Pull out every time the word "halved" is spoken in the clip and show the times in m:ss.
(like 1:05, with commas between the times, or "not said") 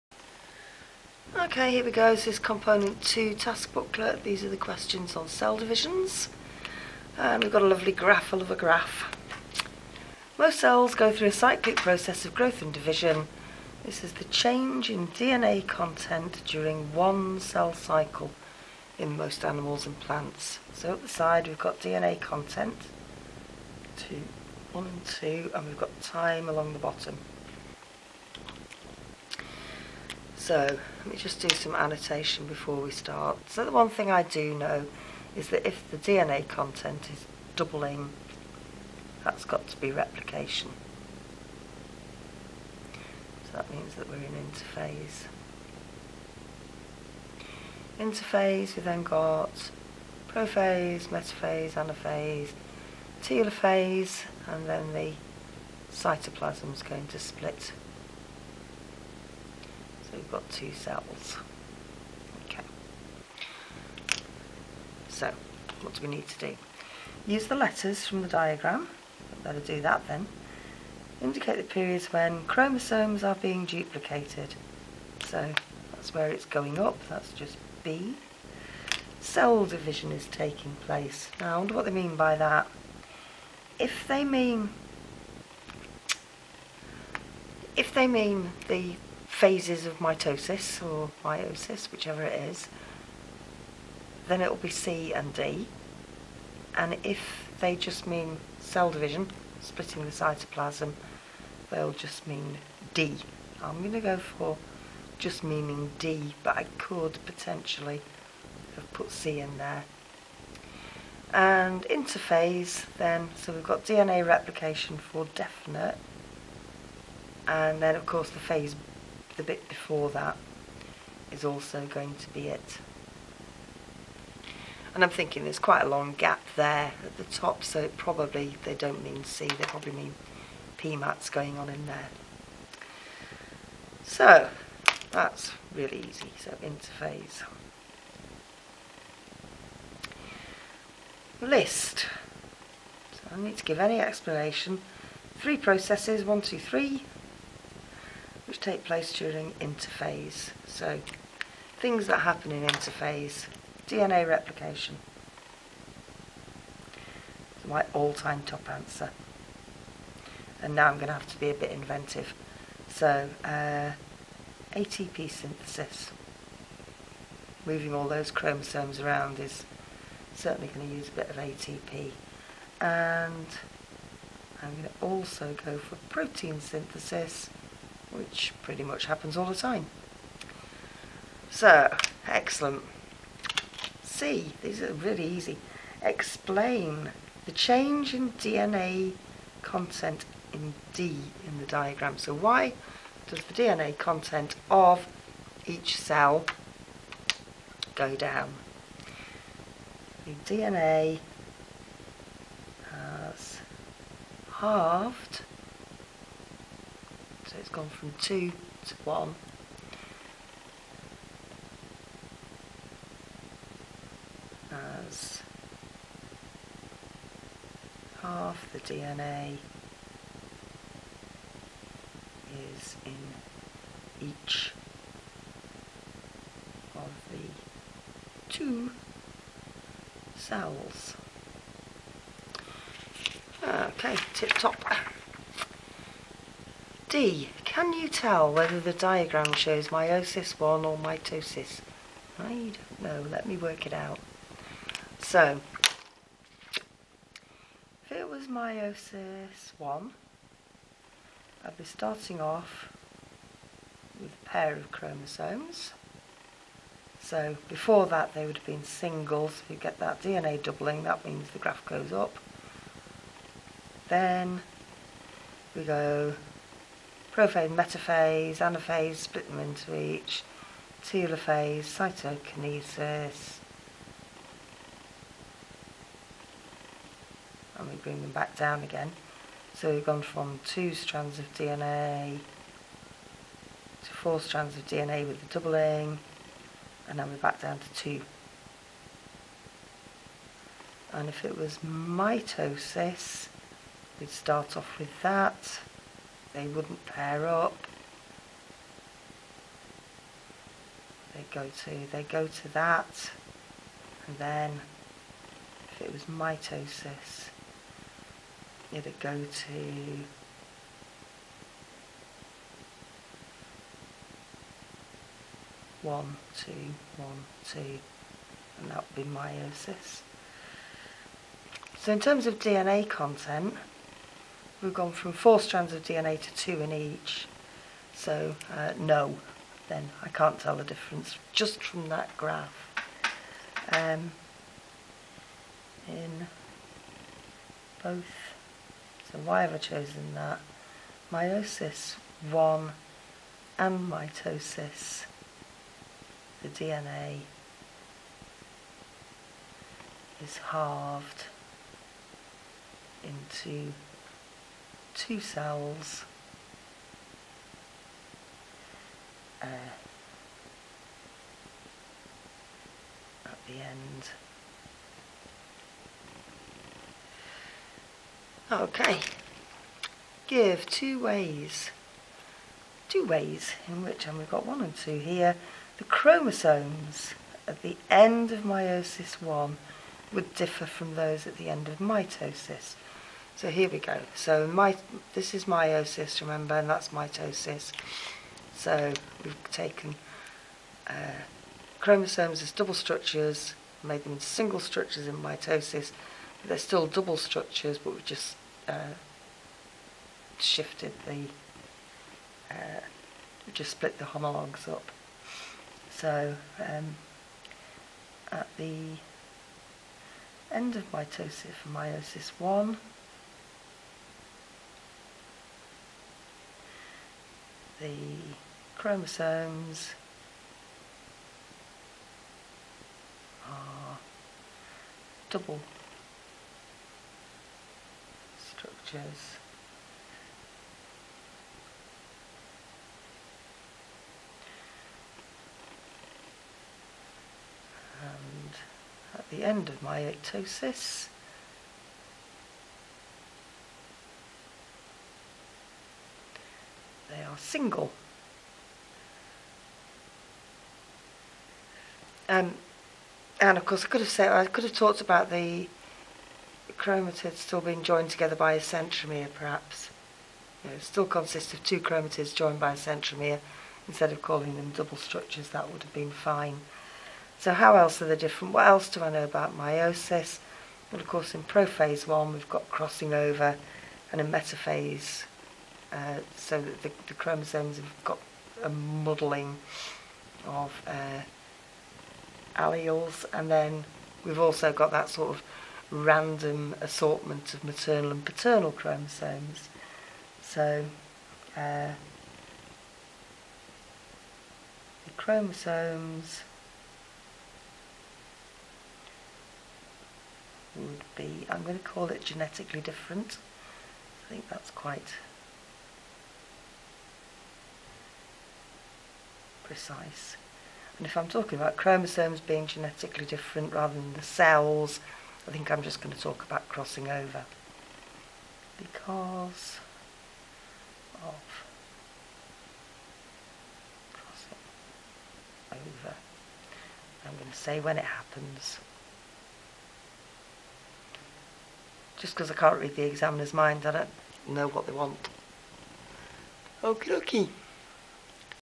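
3:24, 5:50.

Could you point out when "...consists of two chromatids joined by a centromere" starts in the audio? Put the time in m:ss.
7:41.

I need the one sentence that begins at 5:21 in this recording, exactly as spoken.
So in terms of DNA content, we've gone from four strands of DNA to two in each.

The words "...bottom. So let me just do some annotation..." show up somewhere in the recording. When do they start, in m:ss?
0:26.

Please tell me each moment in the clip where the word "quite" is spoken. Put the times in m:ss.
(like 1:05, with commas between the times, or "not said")
2:05, 8:24.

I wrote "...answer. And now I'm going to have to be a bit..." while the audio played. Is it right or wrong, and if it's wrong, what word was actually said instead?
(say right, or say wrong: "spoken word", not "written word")
right.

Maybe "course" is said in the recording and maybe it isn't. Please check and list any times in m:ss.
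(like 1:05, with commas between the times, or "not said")
1:58, 7:33, 7:51.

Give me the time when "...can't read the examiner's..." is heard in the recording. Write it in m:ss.
8:52.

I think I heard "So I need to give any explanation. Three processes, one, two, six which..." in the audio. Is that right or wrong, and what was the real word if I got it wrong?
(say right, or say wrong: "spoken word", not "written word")
wrong: "three", not "six".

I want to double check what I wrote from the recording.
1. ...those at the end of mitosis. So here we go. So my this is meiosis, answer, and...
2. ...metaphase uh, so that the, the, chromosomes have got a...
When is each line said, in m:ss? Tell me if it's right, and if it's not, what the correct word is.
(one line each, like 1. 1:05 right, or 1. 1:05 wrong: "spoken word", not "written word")
1. 6:21 wrong: "remember", not "answer"
2. 7:54 right.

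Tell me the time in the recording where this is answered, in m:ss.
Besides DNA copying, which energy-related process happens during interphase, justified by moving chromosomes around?
2:44.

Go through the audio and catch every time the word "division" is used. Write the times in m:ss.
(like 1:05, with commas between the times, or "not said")
0:05, 0:12, 1:19, 1:38.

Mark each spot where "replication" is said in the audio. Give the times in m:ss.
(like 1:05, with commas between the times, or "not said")
0:39, 1:54, 2:34.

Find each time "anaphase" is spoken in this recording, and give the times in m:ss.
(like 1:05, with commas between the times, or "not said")
0:51, 4:28.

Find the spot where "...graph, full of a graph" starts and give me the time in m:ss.
0:07.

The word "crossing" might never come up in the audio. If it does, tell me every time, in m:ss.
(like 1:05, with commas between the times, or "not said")
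7:52, 8:36, 8:44.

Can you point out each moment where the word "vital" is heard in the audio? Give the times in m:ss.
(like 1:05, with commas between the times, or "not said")
not said.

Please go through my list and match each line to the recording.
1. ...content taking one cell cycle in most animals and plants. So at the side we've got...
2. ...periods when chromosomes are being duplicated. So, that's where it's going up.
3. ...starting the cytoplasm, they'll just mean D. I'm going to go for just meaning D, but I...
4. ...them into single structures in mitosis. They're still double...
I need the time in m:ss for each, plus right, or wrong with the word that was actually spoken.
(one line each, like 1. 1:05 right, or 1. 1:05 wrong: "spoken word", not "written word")
1. 0:15 wrong: "during", not "taking"
2. 1:11 right
3. 1:39 wrong: "splitting", not "starting"
4. 6:34 right.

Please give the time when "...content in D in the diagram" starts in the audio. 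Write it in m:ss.
3:09.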